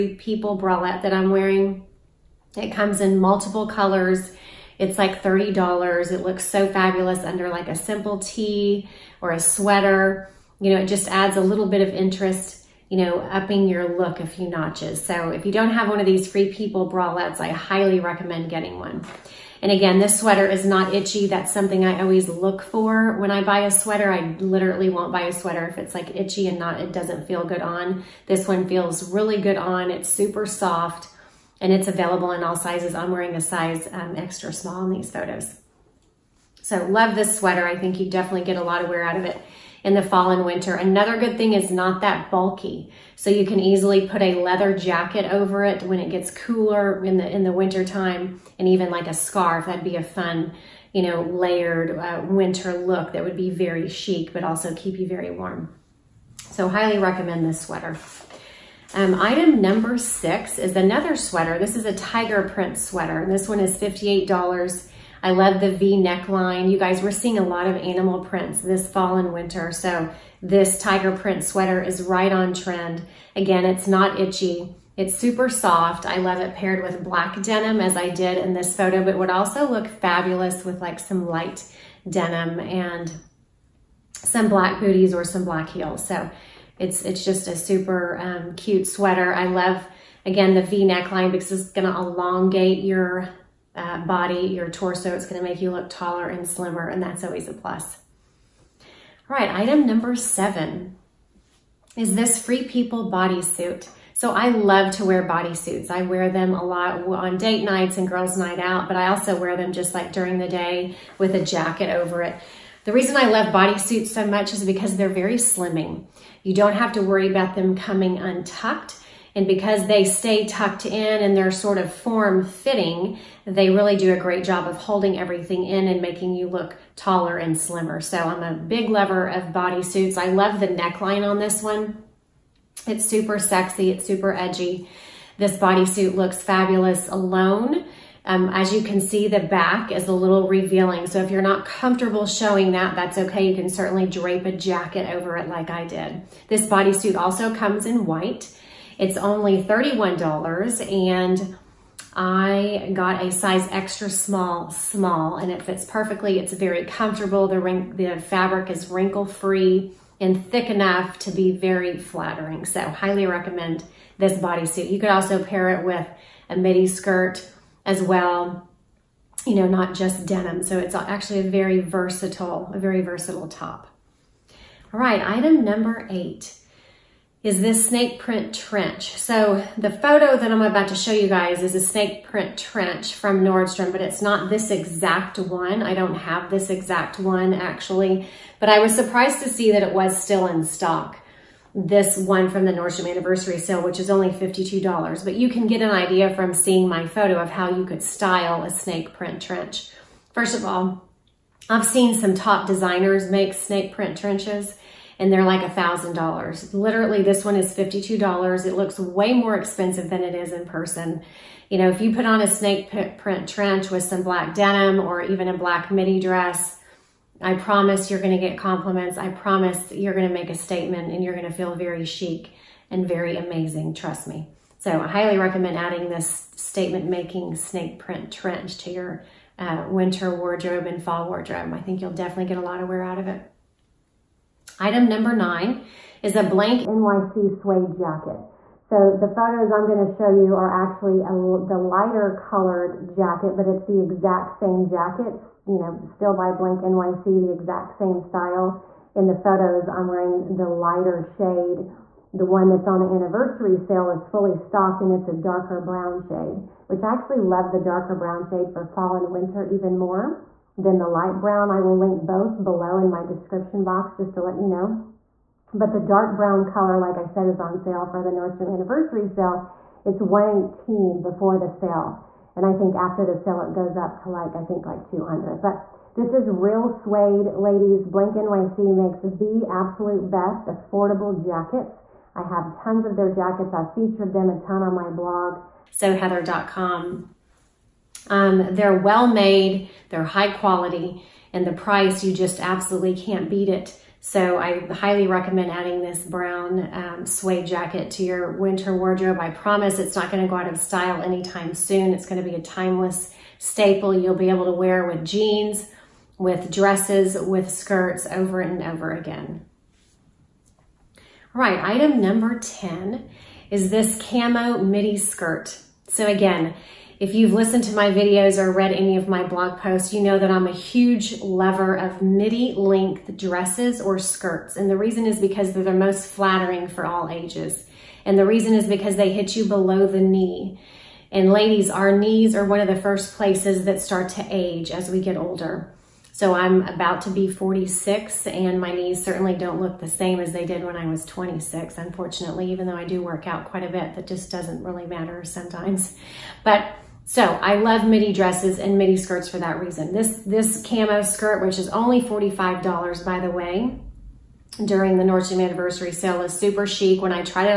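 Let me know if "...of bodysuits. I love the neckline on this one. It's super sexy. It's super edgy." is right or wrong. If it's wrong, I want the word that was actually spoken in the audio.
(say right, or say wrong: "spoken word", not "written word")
right.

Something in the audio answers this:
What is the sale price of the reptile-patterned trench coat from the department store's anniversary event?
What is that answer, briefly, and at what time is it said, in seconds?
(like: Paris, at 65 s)
$52, at 194 s.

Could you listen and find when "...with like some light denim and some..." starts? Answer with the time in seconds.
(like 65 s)
80 s.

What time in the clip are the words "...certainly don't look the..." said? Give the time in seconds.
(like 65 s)
339 s.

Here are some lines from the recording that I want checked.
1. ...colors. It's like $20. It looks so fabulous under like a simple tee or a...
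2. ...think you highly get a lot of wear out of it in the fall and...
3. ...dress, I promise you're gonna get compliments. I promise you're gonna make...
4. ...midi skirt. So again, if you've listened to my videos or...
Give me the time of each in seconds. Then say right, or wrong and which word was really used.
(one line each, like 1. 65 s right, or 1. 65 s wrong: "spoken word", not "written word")
1. 3 s wrong: "30", not "20"
2. 37 s wrong: "definitely", not "highly"
3. 216 s right
4. 314 s right.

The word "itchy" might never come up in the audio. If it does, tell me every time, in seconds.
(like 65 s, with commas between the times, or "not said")
20 s, 26 s, 74 s.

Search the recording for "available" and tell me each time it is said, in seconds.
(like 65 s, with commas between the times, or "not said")
31 s.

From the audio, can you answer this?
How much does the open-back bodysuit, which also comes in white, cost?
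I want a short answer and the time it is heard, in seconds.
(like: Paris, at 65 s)
$31, at 149 s.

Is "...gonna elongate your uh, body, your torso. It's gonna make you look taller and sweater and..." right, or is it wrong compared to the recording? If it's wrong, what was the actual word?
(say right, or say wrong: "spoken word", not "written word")
wrong: "slimmer", not "sweater".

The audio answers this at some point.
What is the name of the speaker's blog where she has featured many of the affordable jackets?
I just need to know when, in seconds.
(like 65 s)
285 s.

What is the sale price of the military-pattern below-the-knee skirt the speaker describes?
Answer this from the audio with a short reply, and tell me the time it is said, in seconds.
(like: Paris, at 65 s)
$45, at 351 s.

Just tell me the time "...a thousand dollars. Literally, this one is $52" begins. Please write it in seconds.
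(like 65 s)
205 s.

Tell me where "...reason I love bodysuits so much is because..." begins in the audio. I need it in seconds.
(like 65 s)
112 s.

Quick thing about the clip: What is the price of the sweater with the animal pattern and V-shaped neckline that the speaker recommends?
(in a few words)
$58.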